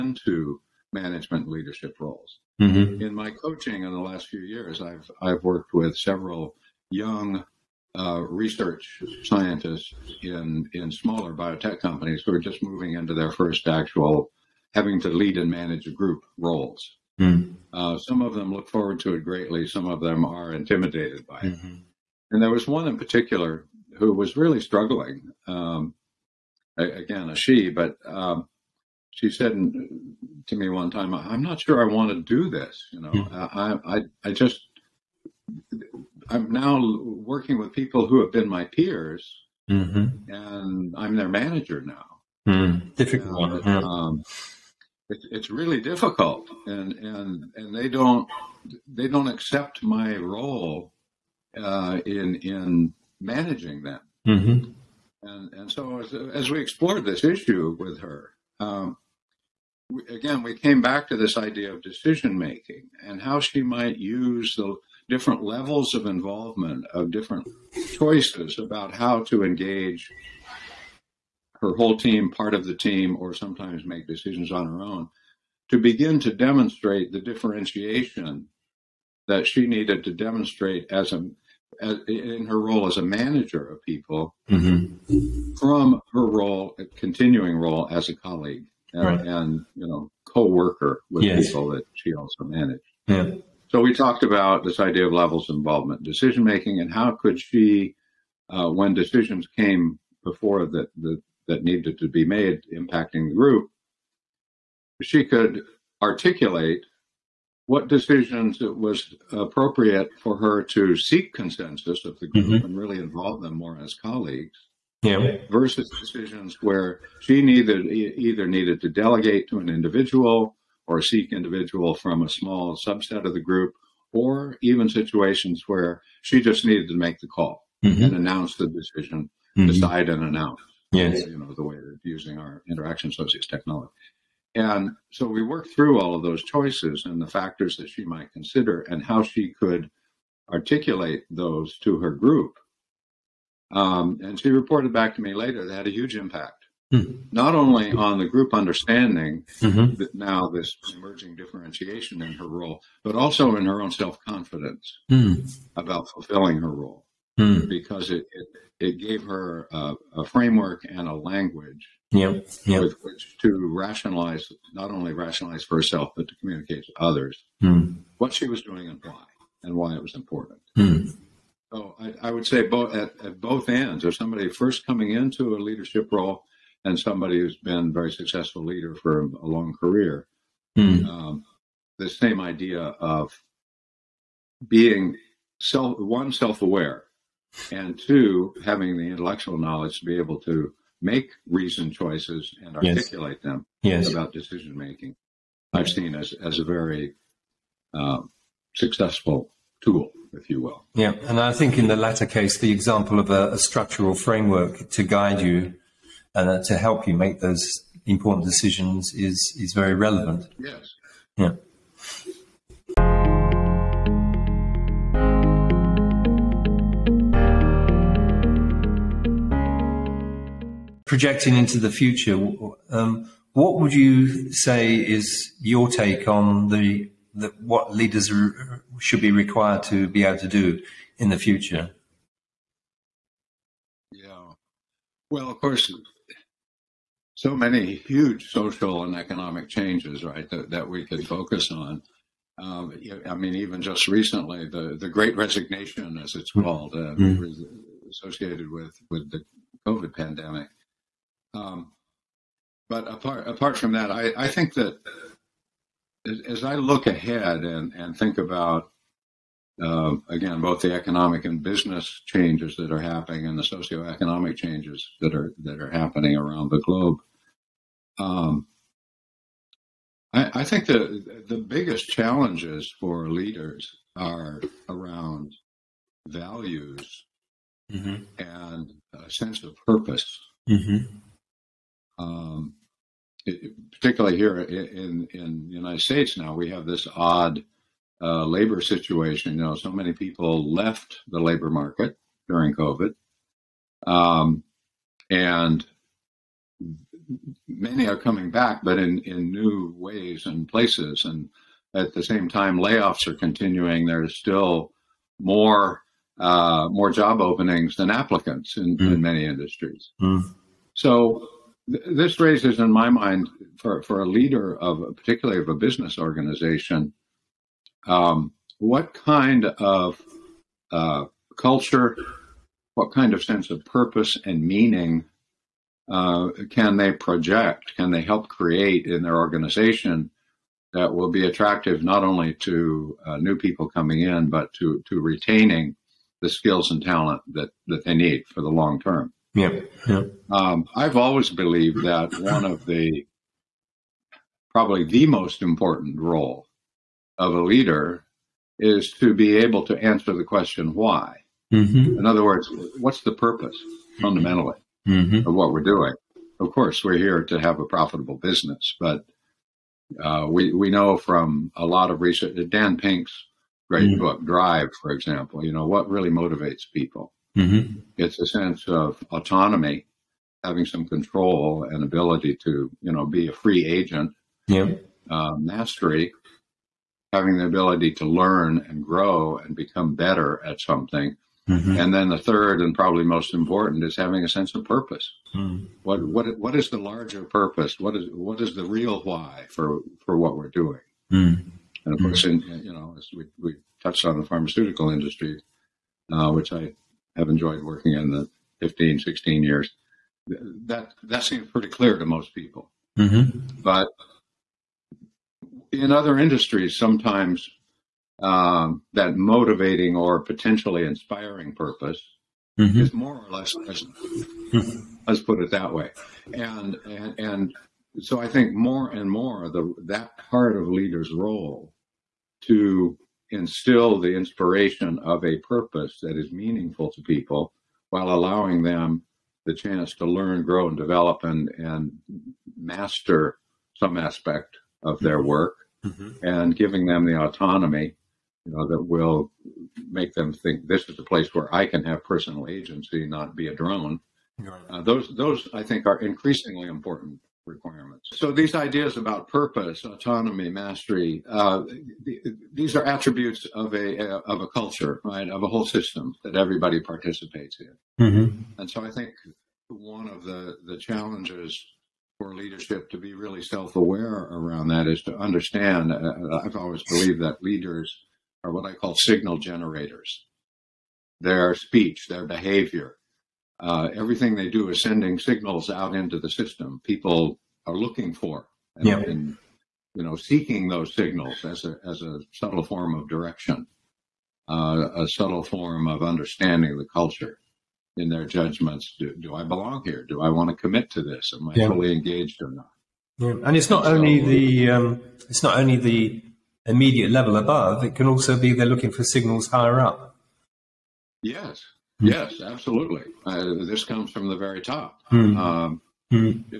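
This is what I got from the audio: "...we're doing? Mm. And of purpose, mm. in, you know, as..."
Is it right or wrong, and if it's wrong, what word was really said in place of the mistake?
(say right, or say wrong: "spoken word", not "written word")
wrong: "course", not "purpose".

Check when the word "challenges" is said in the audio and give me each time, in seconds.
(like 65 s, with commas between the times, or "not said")
272 s, 460 s.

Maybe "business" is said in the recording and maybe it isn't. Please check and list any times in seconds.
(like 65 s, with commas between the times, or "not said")
261 s, 315 s, 358 s.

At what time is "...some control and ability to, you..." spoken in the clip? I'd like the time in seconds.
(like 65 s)
370 s.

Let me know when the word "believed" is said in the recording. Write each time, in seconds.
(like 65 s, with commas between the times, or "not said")
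341 s, 467 s.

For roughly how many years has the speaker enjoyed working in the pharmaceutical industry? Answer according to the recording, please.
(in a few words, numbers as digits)
16.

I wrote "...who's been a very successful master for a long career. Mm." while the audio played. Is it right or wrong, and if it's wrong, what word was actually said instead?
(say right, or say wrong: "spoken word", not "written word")
wrong: "leader", not "master".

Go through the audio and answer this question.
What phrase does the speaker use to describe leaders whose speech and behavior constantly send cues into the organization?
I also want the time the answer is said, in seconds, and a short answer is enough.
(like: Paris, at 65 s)
signal generators, at 469 s.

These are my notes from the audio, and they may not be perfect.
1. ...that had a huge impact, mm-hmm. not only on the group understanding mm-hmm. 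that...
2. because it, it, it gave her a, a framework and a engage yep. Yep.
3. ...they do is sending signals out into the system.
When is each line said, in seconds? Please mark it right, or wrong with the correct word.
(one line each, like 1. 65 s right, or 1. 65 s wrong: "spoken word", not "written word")
1. 145 s right
2. 157 s wrong: "language", not "engage"
3. 474 s right.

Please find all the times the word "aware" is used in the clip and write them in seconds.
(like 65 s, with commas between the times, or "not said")
186 s, 463 s.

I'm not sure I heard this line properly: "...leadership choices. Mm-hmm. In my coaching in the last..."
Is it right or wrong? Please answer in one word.
wrong.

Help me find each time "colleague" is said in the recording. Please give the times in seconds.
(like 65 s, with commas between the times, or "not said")
88 s, 113 s.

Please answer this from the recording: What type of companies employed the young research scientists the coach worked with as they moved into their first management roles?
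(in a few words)
smaller biotech companies.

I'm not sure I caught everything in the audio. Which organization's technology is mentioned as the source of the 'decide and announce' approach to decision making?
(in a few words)
Interaction Associates.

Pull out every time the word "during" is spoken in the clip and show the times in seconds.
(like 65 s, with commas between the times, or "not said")
292 s.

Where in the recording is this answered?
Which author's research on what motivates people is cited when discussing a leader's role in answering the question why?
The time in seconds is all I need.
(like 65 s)
362 s.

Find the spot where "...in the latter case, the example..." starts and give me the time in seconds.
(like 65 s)
201 s.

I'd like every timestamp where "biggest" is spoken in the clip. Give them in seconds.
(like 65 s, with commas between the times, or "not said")
271 s.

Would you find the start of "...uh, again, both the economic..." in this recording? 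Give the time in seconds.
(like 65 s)
259 s.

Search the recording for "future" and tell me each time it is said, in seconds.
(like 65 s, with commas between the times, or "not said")
221 s, 231 s.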